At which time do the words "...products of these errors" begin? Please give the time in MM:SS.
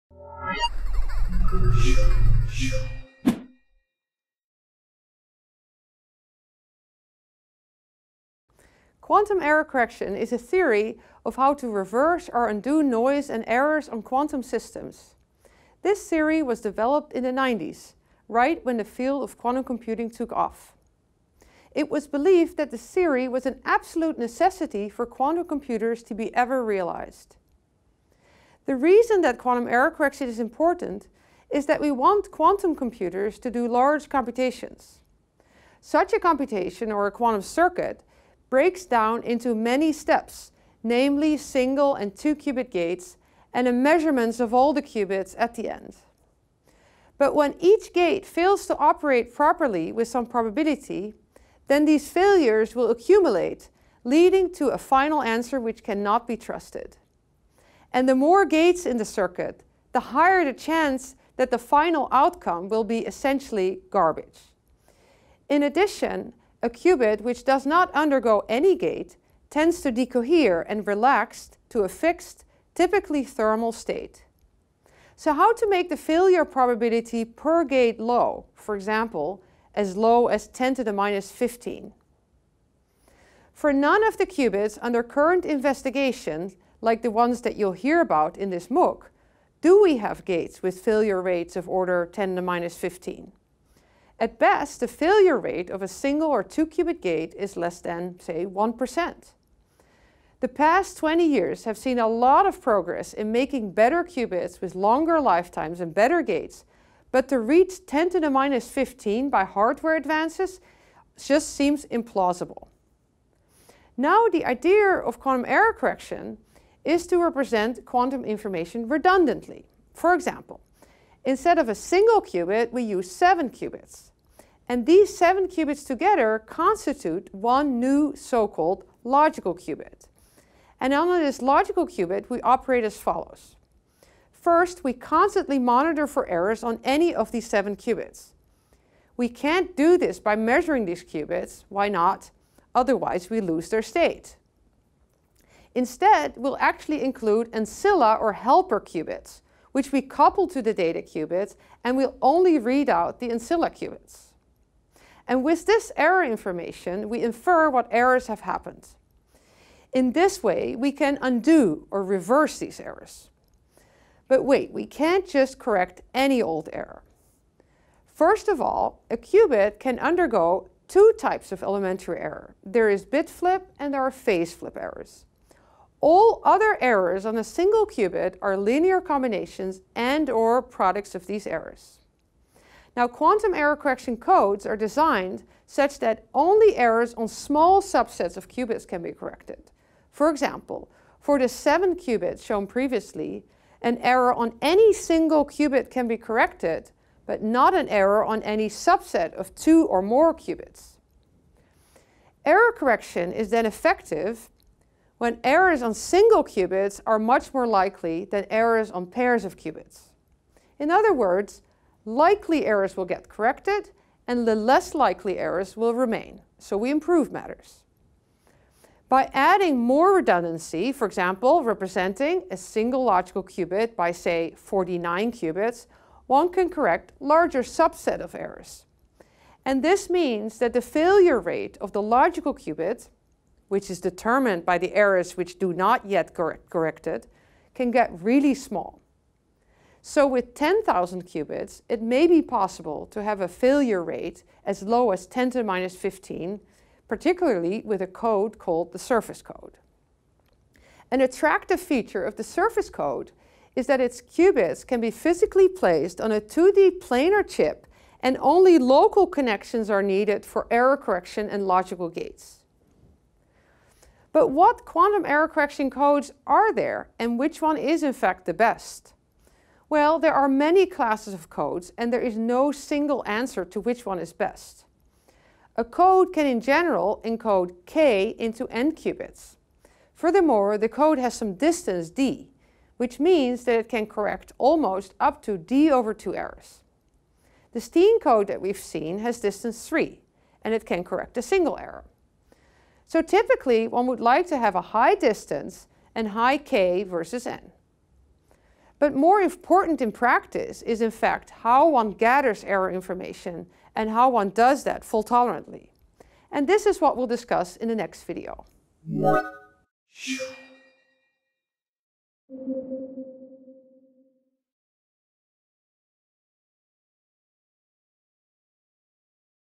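03:00.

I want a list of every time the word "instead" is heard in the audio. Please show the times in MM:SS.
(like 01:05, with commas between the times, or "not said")
02:01, 02:25.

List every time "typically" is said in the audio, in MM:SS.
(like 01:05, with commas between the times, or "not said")
01:12, 04:53.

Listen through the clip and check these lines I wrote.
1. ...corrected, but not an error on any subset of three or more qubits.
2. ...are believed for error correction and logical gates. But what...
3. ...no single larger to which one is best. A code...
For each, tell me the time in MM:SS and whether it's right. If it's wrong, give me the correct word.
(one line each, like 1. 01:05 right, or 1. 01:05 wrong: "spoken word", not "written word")
1. 03:16 wrong: "two", not "three"
2. 04:19 wrong: "needed", not "believed"
3. 04:32 wrong: "answer", not "larger".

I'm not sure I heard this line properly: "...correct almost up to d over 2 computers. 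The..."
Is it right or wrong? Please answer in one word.
wrong.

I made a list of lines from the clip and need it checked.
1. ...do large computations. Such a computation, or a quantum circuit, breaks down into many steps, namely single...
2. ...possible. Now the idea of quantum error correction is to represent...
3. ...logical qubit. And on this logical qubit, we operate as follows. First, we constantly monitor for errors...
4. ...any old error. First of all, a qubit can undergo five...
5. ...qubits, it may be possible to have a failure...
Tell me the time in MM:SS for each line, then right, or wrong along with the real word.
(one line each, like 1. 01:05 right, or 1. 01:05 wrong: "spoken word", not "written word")
1. 00:33 right
2. 01:51 wrong: "implausible", not "possible"
3. 02:09 right
4. 02:46 wrong: "two", not "five"
5. 04:01 right.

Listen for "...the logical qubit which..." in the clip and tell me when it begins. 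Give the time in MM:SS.
03:51.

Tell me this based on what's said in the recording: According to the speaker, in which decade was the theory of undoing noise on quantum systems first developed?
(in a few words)
the 90s.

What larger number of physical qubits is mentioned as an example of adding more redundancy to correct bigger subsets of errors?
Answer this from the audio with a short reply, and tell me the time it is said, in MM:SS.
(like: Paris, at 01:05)
49, at 03:44.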